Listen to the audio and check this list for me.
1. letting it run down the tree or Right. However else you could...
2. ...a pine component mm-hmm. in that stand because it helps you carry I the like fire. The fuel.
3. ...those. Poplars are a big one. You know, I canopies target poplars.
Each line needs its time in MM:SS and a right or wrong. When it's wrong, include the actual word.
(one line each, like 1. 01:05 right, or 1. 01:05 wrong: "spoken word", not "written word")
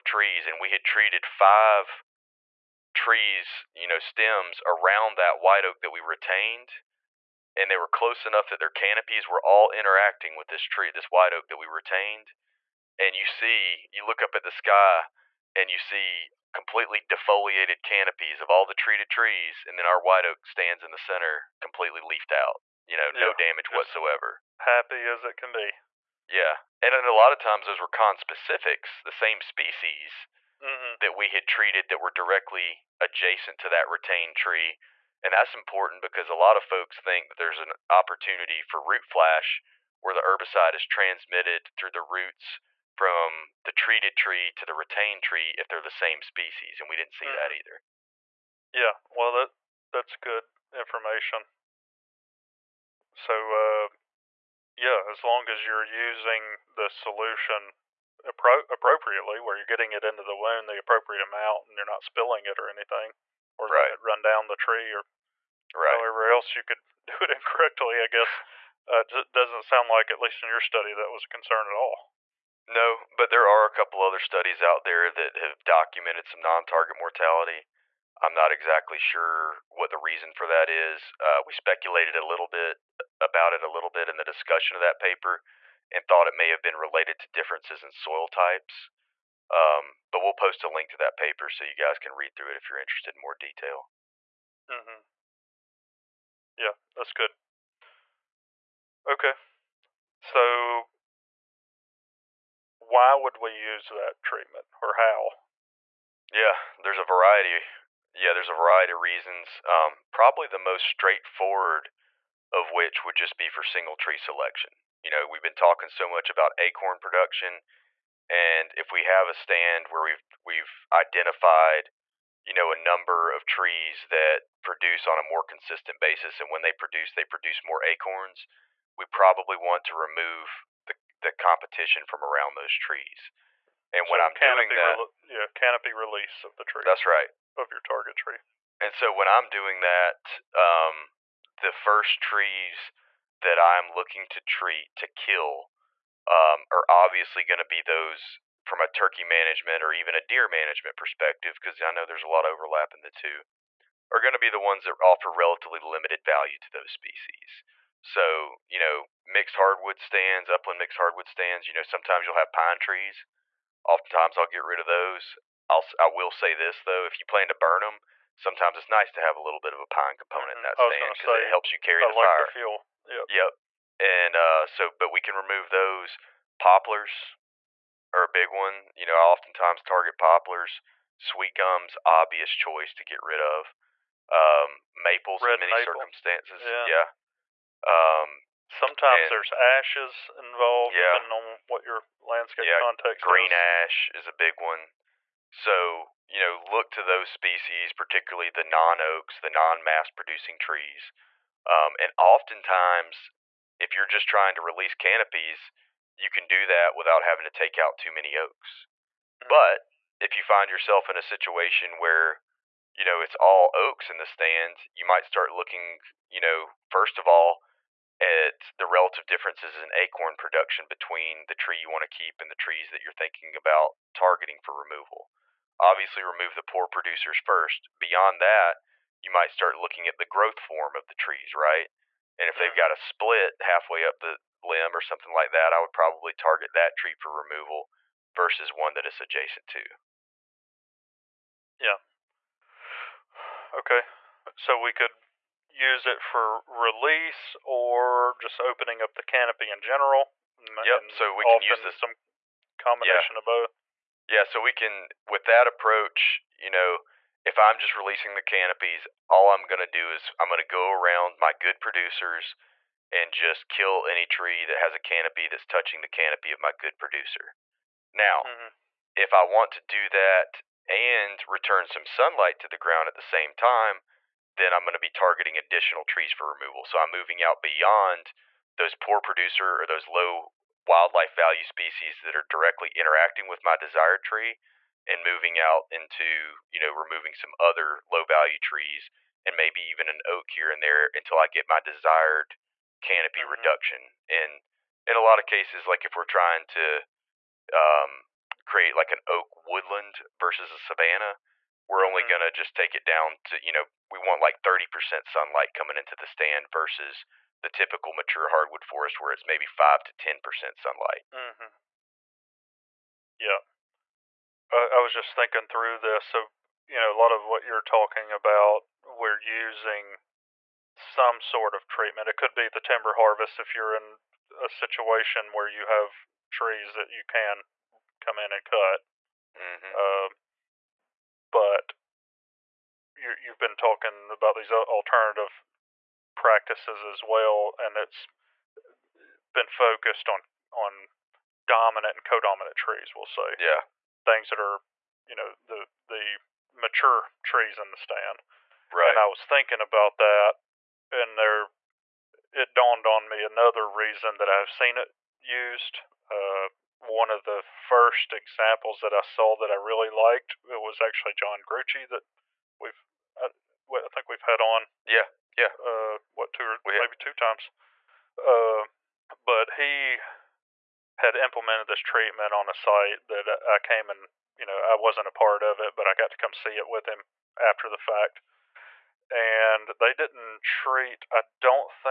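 1. 01:03 right
2. 02:49 right
3. 02:55 wrong: "oftentimes", not "canopies".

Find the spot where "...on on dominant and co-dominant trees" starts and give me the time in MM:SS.
05:40.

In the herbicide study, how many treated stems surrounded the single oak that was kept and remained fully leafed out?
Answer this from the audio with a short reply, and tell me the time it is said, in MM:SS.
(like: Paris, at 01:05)
5, at 00:01.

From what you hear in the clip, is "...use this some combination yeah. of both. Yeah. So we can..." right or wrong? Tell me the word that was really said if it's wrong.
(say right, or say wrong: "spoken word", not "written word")
right.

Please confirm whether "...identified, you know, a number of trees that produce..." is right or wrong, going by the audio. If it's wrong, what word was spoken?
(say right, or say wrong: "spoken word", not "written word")
right.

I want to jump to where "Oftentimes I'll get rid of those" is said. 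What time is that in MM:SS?
02:43.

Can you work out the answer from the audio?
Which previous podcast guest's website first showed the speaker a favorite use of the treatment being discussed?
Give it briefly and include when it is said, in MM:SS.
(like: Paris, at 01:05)
John Gruchy, at 06:01.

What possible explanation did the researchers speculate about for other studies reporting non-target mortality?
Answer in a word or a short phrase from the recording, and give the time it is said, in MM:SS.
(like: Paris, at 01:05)
Differences in soil types, at 01:27.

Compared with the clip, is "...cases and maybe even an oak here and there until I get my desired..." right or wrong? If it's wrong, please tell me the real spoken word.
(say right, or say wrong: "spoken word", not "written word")
wrong: "trees", not "cases".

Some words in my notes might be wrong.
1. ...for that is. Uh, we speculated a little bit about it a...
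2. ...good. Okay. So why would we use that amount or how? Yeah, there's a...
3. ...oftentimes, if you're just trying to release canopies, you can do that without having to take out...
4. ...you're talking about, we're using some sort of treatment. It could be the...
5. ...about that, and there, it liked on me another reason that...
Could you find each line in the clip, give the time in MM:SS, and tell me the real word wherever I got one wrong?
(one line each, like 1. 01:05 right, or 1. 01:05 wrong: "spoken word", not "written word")
1. 01:20 right
2. 01:37 wrong: "treatment", not "amount"
3. 03:22 right
4. 05:17 right
5. 05:49 wrong: "dawned", not "liked".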